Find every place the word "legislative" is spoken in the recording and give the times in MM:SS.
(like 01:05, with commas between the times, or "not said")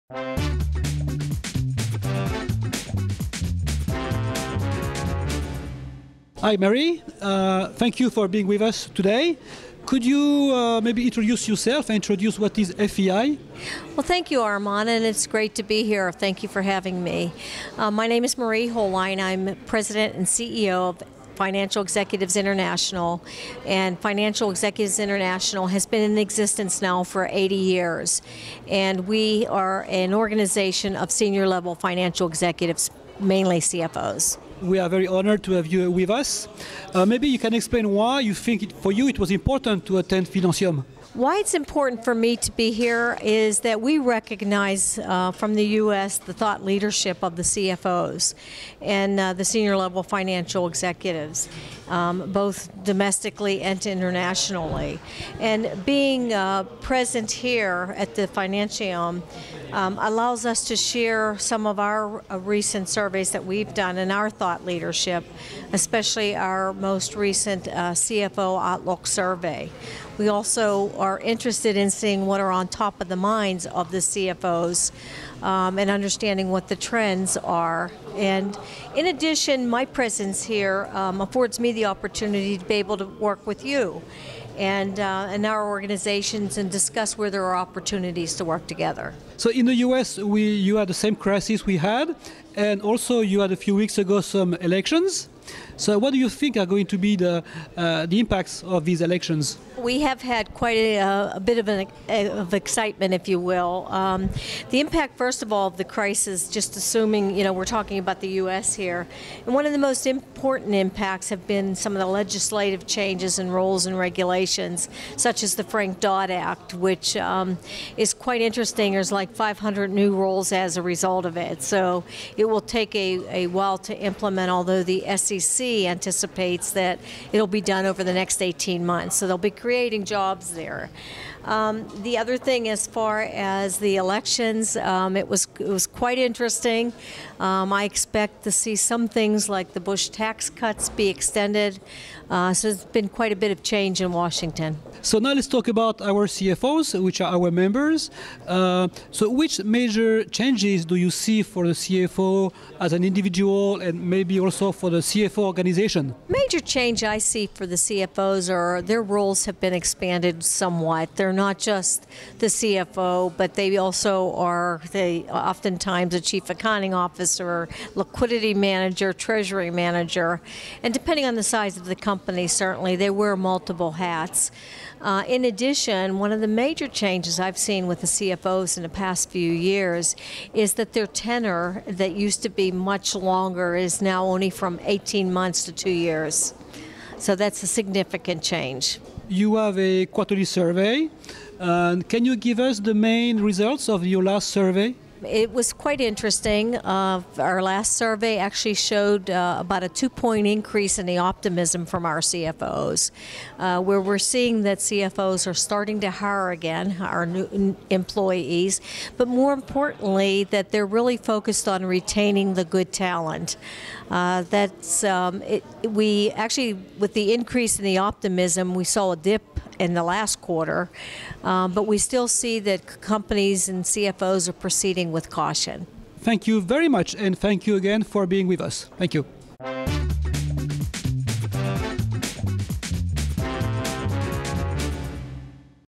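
01:52.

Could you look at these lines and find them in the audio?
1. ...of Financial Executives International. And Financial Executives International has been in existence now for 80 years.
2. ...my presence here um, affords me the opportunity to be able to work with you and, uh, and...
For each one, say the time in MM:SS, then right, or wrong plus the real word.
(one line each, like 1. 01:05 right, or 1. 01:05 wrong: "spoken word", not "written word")
1. 00:20 right
2. 01:19 right.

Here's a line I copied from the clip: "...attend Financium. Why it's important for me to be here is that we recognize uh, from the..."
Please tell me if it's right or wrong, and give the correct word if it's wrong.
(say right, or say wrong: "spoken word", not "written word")
right.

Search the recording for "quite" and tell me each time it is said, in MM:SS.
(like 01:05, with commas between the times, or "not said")
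01:40, 01:58, 02:15, 02:23, 03:15.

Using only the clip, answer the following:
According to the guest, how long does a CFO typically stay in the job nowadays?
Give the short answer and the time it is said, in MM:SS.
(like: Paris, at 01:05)
18 months to 2 years, at 03:04.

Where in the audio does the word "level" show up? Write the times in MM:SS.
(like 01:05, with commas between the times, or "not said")
00:31, 00:49.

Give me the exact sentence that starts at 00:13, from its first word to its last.
Well, thank you, Armand, and it's great to be here.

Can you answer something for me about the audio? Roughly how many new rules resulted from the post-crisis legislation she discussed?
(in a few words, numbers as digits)
500.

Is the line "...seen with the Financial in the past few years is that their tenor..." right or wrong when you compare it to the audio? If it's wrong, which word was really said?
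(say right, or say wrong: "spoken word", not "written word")
wrong: "CFOs", not "Financial".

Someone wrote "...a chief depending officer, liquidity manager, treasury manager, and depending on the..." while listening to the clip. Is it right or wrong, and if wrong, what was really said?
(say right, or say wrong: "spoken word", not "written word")
wrong: "accounting", not "depending".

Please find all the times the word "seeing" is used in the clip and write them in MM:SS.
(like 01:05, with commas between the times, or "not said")
01:11, 03:24.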